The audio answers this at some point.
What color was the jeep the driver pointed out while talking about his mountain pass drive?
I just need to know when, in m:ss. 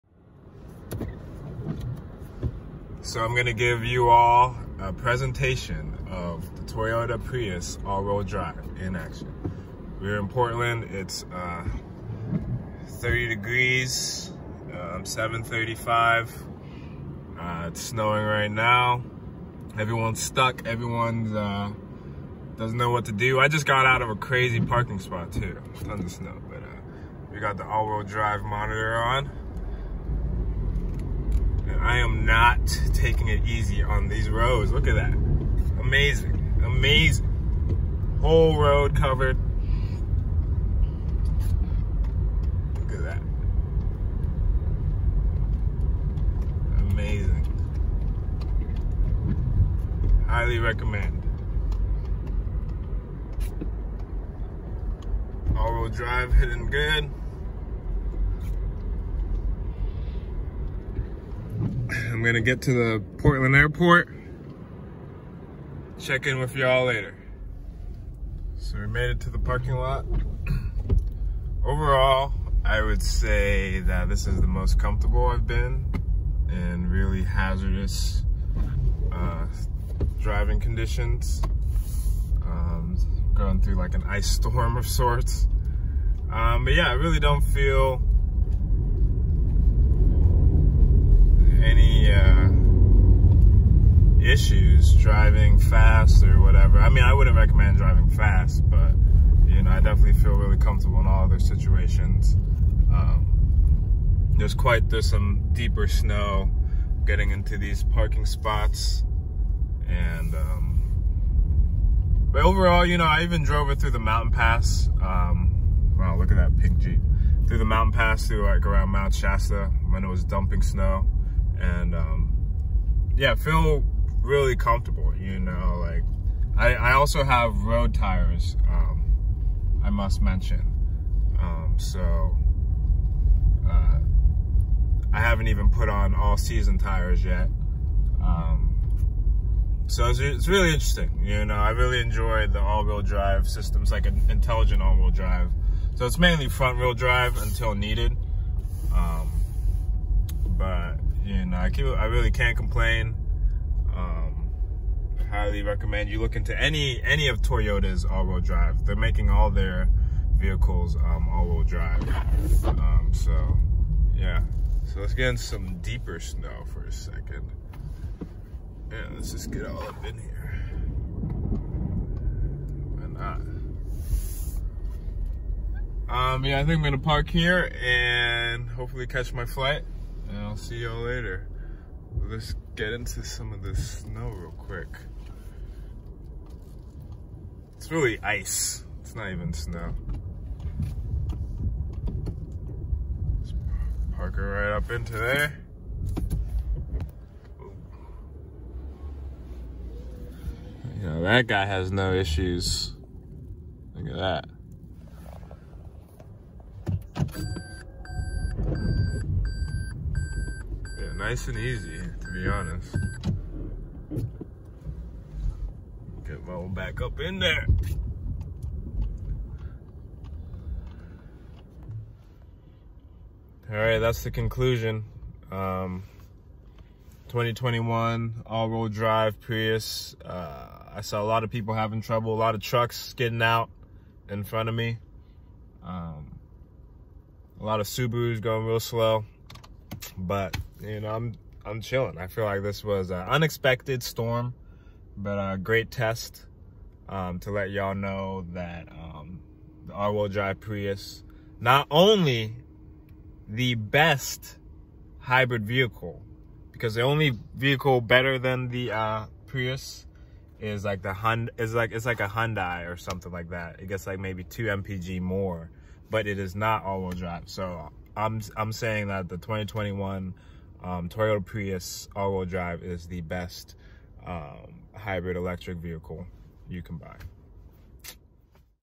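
1:56.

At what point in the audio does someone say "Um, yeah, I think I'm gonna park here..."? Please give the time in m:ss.
2:56.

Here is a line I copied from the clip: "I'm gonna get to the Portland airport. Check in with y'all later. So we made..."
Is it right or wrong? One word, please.
right.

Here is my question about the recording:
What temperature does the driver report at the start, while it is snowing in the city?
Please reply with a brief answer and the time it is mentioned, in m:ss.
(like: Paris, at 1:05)
30 degrees, at 0:12.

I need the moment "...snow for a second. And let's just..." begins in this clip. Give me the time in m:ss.
2:46.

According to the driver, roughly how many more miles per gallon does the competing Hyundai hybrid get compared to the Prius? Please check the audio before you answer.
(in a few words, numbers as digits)
2 mpg.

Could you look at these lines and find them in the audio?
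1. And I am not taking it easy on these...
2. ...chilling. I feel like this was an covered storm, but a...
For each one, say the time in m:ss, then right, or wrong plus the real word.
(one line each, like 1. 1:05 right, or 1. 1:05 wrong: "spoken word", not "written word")
1. 0:31 right
2. 4:01 wrong: "unexpected", not "covered".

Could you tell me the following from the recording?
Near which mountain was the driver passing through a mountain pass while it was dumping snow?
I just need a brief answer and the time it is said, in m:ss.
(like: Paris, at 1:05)
Mount Shasta, at 1:58.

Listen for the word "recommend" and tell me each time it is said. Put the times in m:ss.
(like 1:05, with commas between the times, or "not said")
0:50, 1:37, 2:35.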